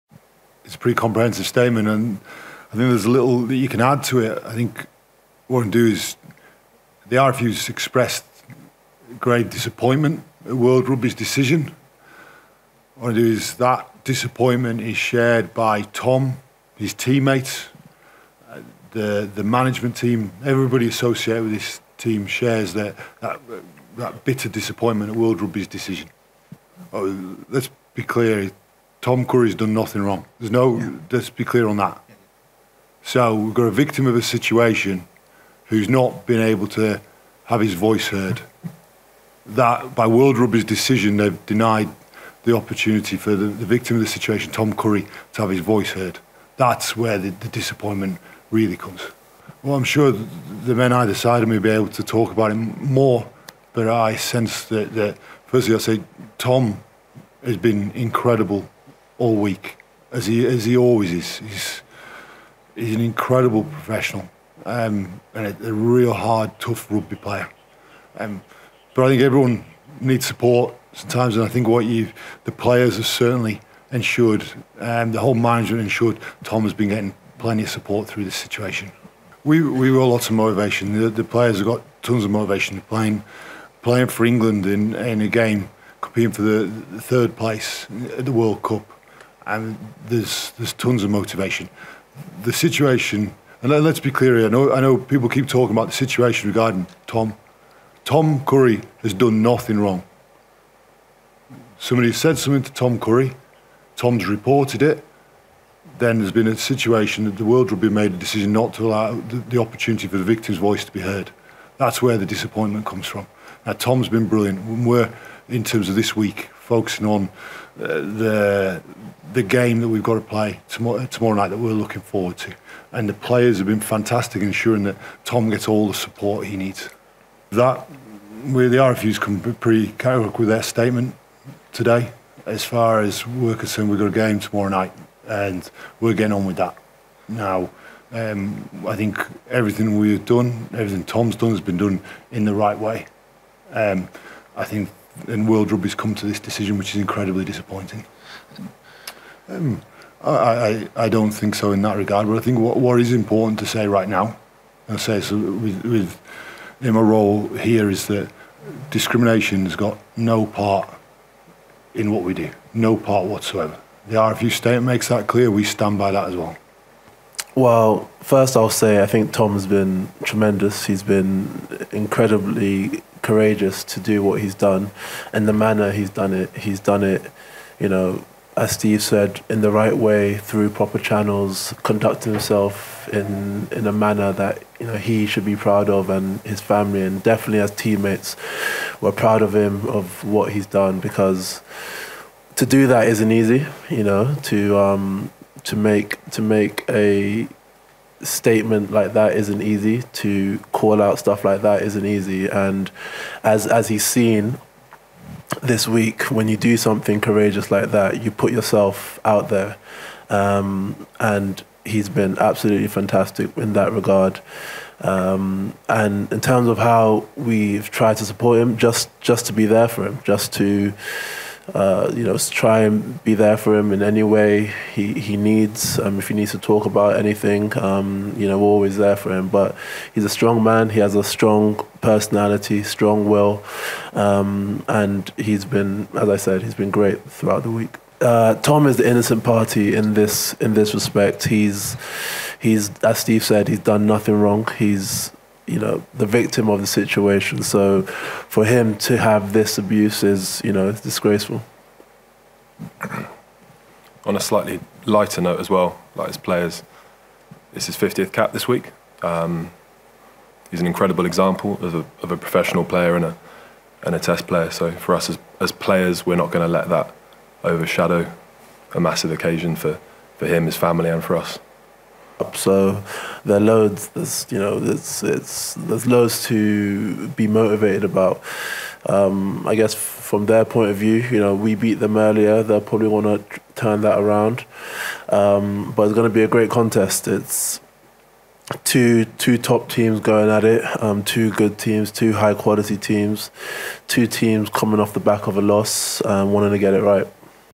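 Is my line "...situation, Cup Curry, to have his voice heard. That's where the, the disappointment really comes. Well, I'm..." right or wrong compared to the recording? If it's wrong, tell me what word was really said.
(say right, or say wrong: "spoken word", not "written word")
wrong: "Tom", not "Cup".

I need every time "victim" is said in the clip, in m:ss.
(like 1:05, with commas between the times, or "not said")
0:33, 0:43, 1:50, 4:06.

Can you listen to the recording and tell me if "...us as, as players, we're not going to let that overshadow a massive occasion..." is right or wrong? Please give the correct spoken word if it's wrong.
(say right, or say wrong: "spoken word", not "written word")
right.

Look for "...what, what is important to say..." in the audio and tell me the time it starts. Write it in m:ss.
2:32.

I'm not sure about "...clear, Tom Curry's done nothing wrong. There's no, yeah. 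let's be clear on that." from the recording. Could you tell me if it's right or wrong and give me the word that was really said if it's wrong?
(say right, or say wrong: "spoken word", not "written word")
right.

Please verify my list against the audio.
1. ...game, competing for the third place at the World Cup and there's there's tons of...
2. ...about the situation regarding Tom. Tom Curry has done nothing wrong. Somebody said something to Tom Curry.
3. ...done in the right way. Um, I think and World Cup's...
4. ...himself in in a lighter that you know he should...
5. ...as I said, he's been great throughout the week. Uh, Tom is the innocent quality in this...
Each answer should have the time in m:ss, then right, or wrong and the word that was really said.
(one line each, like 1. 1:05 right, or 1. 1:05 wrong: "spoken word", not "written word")
1. 1:25 right
2. 1:35 right
3. 2:21 wrong: "Rugby", not "Cup"
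4. 3:02 wrong: "manner", not "lighter"
5. 3:56 wrong: "party", not "quality".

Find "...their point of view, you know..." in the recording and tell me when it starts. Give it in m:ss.
4:40.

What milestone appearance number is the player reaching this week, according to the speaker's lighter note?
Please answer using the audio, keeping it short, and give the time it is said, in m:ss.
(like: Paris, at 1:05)
50th cap, at 4:17.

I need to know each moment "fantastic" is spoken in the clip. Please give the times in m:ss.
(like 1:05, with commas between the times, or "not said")
2:03, 3:32.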